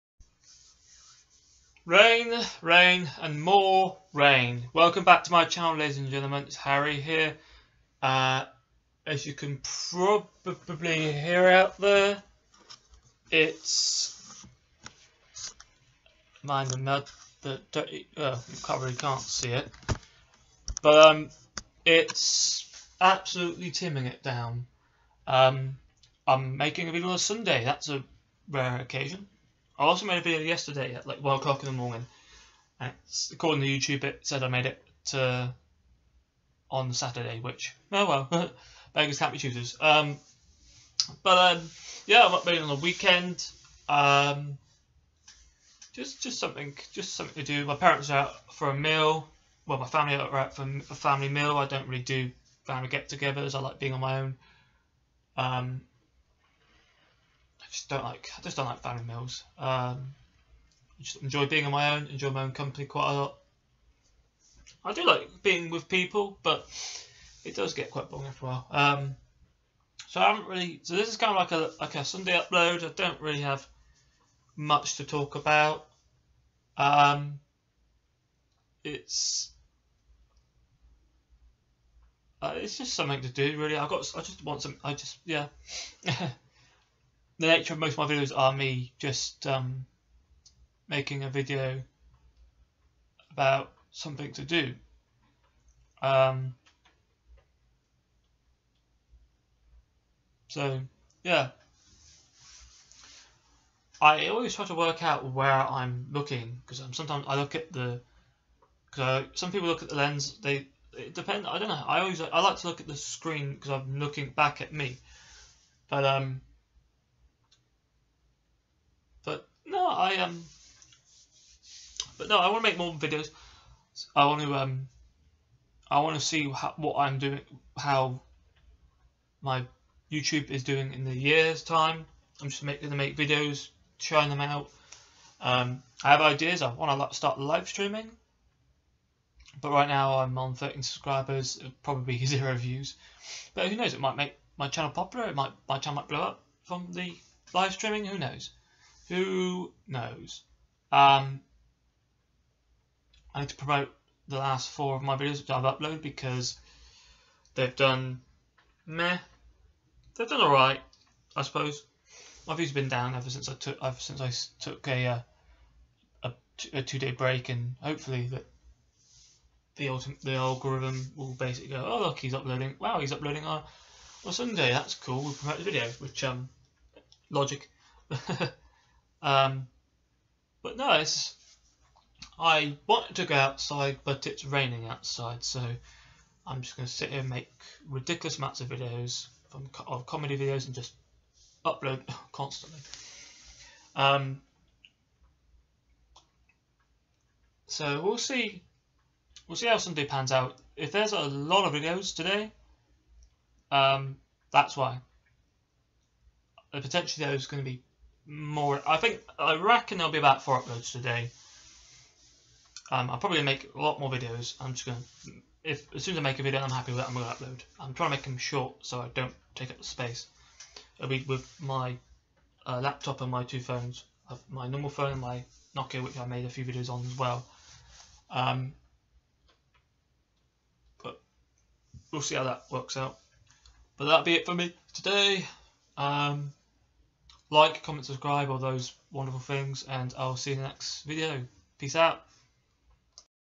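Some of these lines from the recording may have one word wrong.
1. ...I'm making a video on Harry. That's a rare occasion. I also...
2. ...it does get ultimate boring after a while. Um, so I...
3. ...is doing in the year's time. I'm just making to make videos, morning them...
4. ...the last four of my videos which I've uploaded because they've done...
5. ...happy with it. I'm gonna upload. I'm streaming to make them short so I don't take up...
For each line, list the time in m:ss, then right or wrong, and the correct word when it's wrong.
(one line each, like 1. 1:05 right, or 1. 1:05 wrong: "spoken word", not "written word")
1. 0:26 wrong: "Sunday", not "Harry"
2. 1:07 wrong: "quite", not "ultimate"
3. 2:10 wrong: "trying", not "morning"
4. 2:34 right
5. 3:36 wrong: "trying", not "streaming".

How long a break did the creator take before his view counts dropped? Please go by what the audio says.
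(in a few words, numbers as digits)
two day.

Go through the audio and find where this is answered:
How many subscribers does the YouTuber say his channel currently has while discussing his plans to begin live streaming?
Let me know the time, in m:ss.
2:20.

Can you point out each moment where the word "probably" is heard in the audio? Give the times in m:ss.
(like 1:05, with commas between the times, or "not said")
0:09, 0:18, 2:21, 3:33.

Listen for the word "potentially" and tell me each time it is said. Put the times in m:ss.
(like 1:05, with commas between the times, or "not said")
3:26.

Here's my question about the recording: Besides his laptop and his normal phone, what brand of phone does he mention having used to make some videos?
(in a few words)
Nokia.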